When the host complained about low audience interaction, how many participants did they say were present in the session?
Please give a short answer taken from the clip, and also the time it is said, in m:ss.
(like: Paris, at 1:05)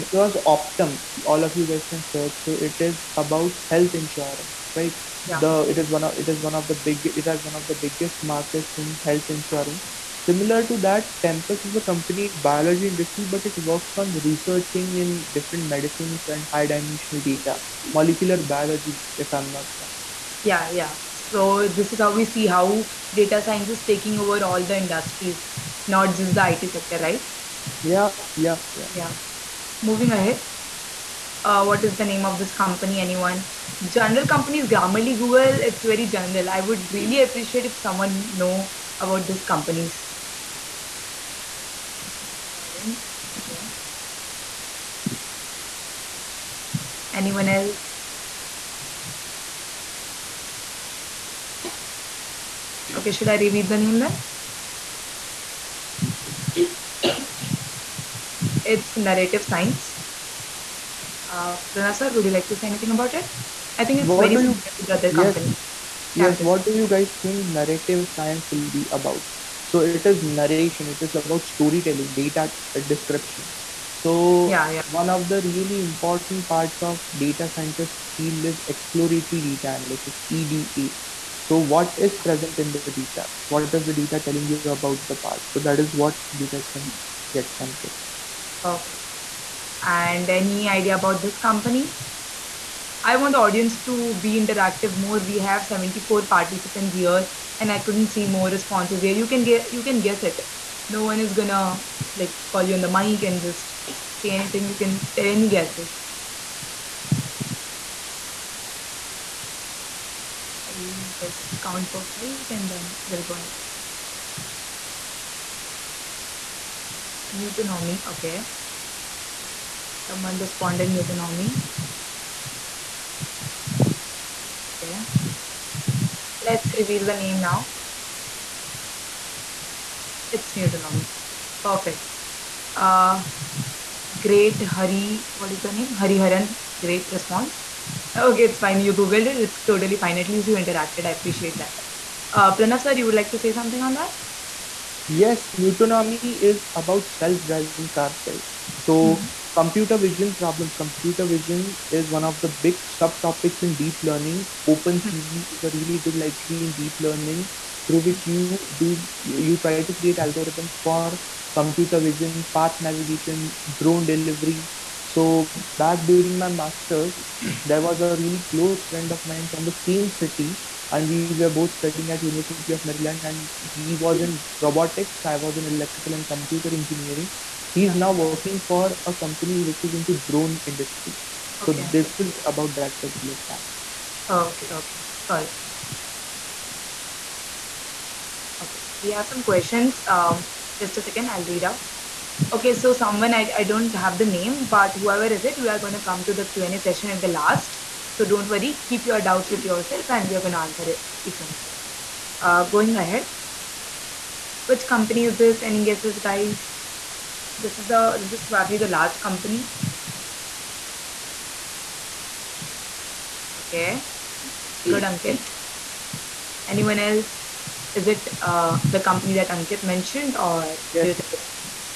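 74, at 1:35.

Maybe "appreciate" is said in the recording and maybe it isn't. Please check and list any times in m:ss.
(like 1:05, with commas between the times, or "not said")
0:37, 2:21.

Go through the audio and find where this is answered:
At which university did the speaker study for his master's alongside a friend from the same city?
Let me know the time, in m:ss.
2:52.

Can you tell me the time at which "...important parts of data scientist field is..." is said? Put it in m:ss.
1:15.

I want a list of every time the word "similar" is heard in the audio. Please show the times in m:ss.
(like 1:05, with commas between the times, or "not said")
0:10, 1:04.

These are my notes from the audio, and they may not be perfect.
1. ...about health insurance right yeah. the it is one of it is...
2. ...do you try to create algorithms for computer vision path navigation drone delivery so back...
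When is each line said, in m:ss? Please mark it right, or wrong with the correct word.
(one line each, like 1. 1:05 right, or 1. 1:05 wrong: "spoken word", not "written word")
1. 0:03 right
2. 2:38 right.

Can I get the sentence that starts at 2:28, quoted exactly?
So mm-hmm computer vision problems computer vision is one of the big subtopics in deep learning opencv hmm.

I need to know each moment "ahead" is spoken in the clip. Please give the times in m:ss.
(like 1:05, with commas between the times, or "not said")
0:30, 1:53, 3:22.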